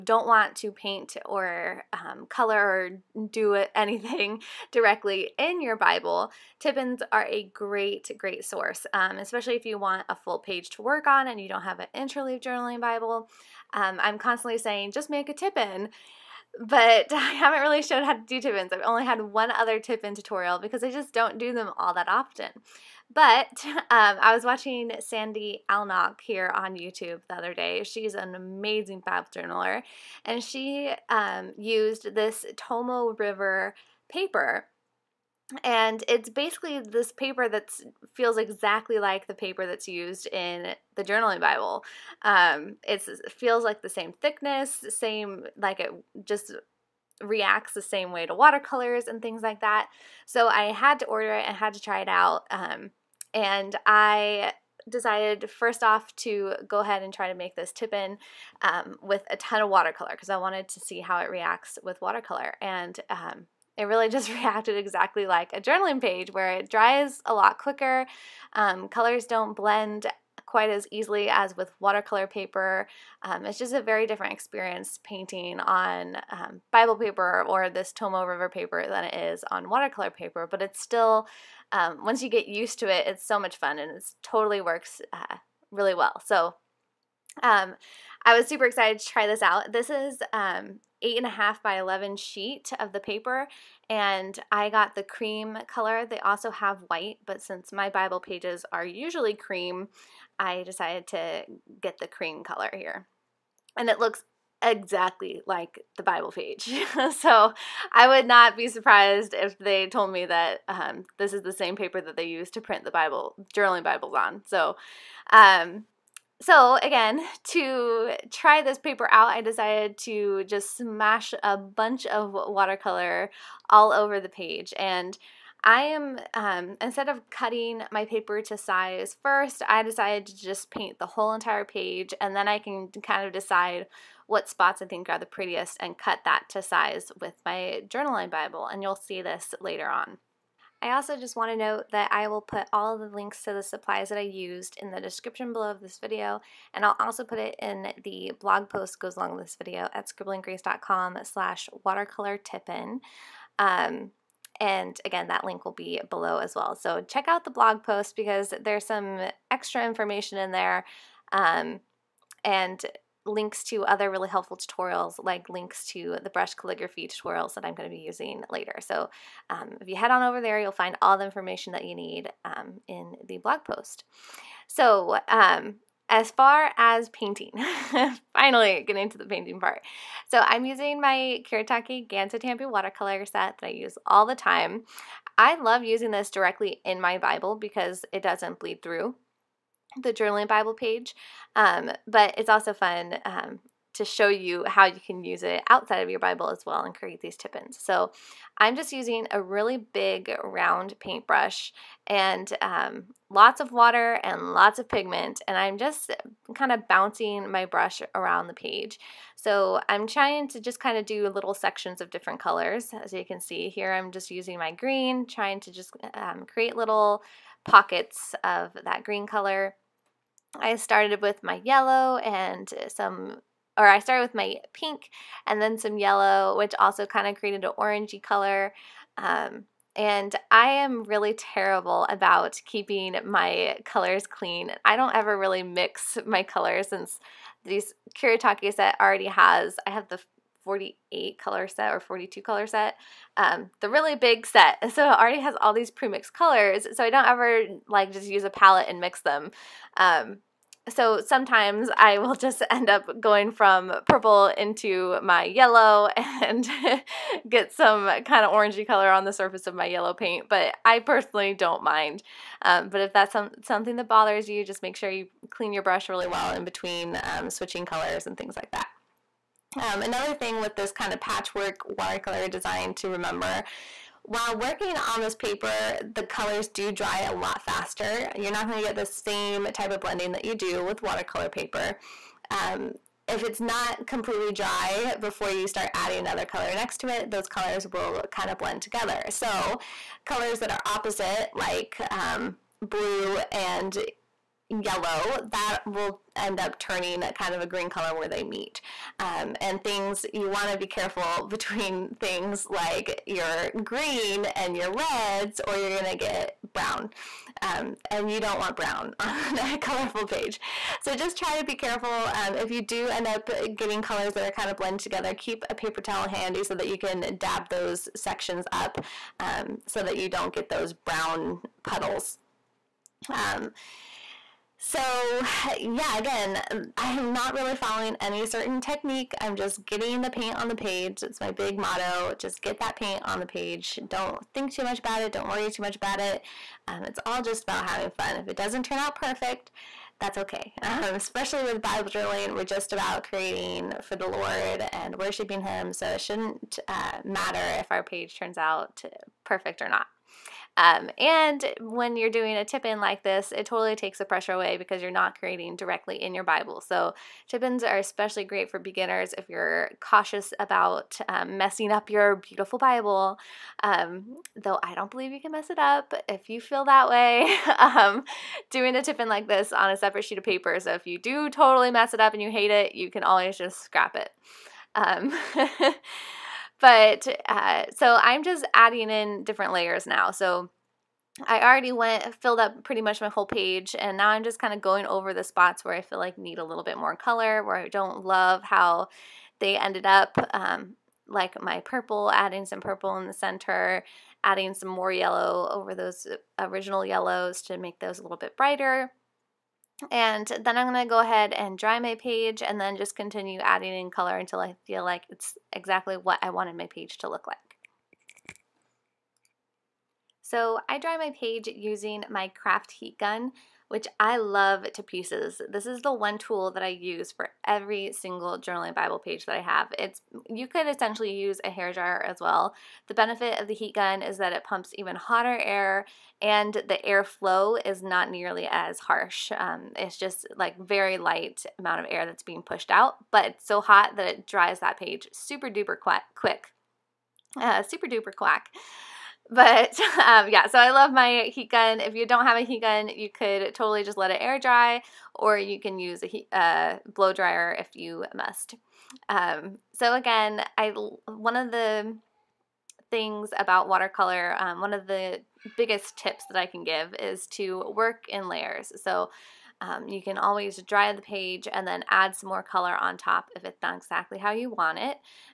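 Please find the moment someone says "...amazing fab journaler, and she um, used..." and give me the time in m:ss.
0:28.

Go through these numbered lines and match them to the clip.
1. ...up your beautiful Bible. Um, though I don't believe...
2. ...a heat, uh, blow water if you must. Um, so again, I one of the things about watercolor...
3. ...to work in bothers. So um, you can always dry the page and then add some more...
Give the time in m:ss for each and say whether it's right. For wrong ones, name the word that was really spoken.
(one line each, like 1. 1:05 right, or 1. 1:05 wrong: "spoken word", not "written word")
1. 6:01 right
2. 7:26 wrong: "dryer", not "water"
3. 7:37 wrong: "layers", not "bothers".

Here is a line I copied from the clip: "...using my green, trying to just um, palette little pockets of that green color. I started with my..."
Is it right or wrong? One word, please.
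wrong.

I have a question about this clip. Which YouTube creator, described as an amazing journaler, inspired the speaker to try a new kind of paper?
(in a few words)
Sandy Allnock.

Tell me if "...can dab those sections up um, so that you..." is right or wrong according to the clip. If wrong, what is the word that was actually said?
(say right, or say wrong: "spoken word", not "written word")
right.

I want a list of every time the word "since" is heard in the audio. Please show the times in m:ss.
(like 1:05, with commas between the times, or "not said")
1:37, 3:56.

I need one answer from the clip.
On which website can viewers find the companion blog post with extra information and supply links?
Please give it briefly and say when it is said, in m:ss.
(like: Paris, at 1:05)
scribblinggrace.com, at 2:30.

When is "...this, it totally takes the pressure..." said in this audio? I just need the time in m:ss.
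5:53.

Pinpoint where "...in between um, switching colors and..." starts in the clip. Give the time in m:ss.
4:26.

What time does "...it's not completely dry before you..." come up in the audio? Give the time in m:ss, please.
4:43.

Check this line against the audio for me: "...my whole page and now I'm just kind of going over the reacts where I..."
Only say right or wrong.
wrong.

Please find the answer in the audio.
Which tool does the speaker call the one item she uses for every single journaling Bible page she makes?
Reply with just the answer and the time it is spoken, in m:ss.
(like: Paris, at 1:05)
craft heat gun, at 6:52.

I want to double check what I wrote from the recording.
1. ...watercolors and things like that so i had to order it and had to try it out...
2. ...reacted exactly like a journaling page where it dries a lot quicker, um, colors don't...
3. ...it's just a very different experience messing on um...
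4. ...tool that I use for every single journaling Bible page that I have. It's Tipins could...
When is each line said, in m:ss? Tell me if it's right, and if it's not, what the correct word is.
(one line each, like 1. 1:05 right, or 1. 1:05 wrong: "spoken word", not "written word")
1. 0:48 right
2. 1:04 right
3. 1:13 wrong: "painting", not "messing"
4. 6:56 wrong: "You", not "Tipins".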